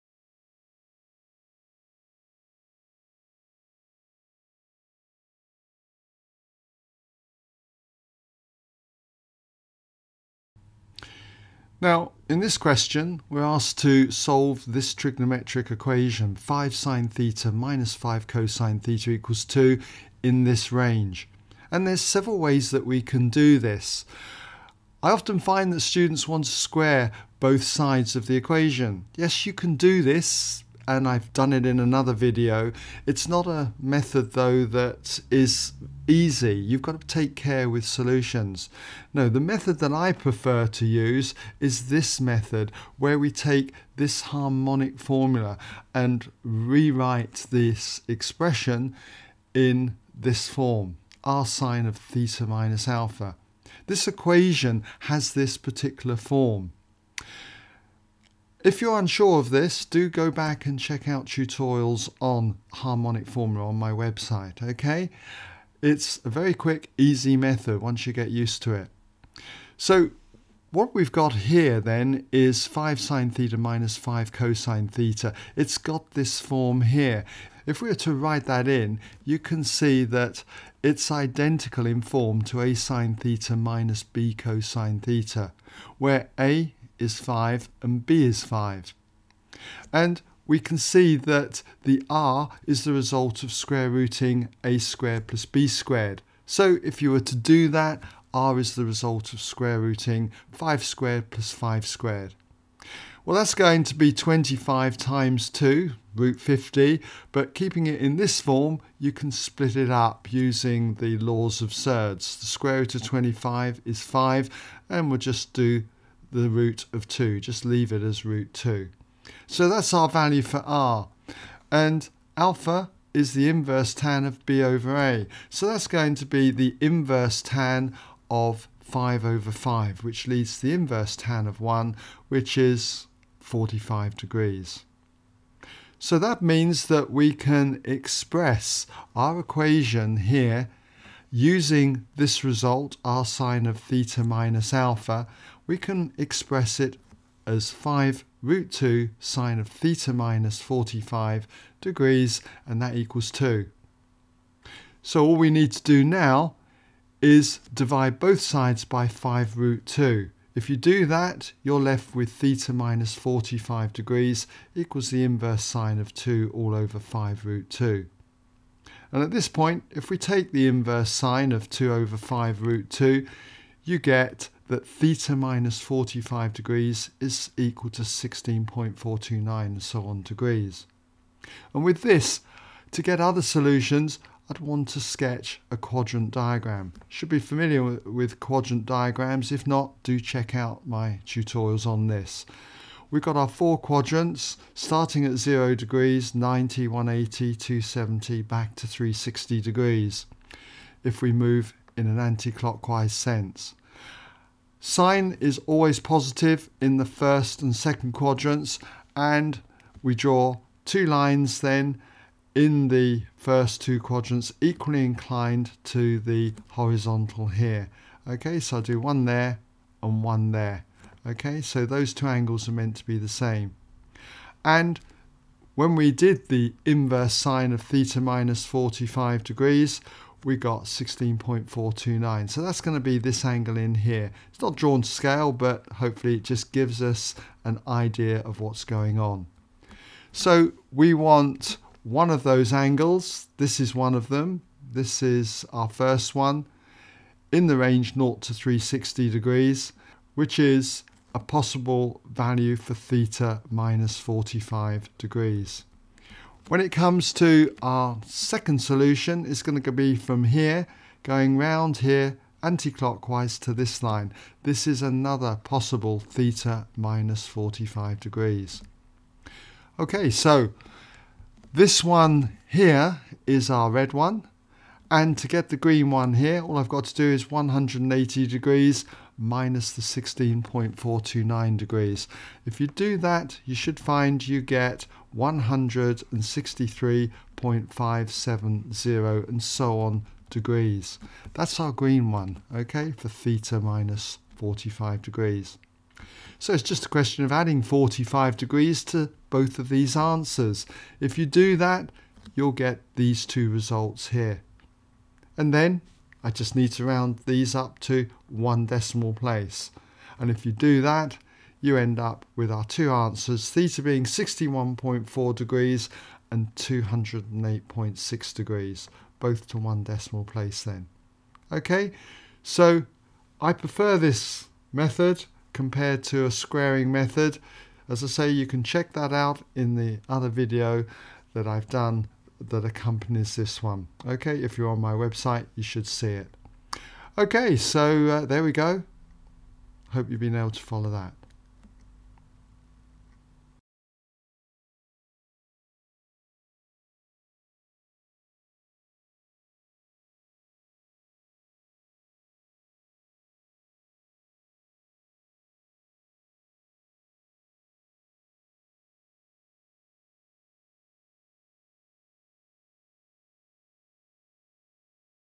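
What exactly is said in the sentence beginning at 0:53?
This equation has this particular form.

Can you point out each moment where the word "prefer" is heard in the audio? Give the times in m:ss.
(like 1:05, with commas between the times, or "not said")
0:40, 5:23.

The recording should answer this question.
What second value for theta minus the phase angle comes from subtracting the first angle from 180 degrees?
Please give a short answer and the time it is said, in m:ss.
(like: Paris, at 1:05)
163.570, at 4:45.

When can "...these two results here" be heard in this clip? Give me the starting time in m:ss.
5:03.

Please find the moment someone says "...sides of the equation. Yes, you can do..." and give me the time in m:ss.
0:27.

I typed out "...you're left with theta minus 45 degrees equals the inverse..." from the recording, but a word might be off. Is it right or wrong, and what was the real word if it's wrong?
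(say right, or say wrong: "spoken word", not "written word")
right.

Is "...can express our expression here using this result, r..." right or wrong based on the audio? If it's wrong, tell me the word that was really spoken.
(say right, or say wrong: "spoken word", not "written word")
wrong: "equation", not "expression".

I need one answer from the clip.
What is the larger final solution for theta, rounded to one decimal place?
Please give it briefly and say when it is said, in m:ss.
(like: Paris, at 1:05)
208.6 degrees, at 5:16.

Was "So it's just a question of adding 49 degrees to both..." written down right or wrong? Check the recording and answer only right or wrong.
wrong.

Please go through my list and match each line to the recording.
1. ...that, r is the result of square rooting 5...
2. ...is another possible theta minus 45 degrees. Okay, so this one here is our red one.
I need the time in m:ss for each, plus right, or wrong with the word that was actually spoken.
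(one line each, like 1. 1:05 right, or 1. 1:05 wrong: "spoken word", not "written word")
1. 1:37 right
2. 4:24 right.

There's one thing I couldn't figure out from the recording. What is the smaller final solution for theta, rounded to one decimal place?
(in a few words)
61.4 degrees.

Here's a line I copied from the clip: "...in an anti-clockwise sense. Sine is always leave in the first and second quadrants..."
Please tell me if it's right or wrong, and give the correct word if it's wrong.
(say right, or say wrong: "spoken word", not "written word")
wrong: "positive", not "leave".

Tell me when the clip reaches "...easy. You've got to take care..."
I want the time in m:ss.
0:36.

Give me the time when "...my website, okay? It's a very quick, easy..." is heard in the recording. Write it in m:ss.
1:03.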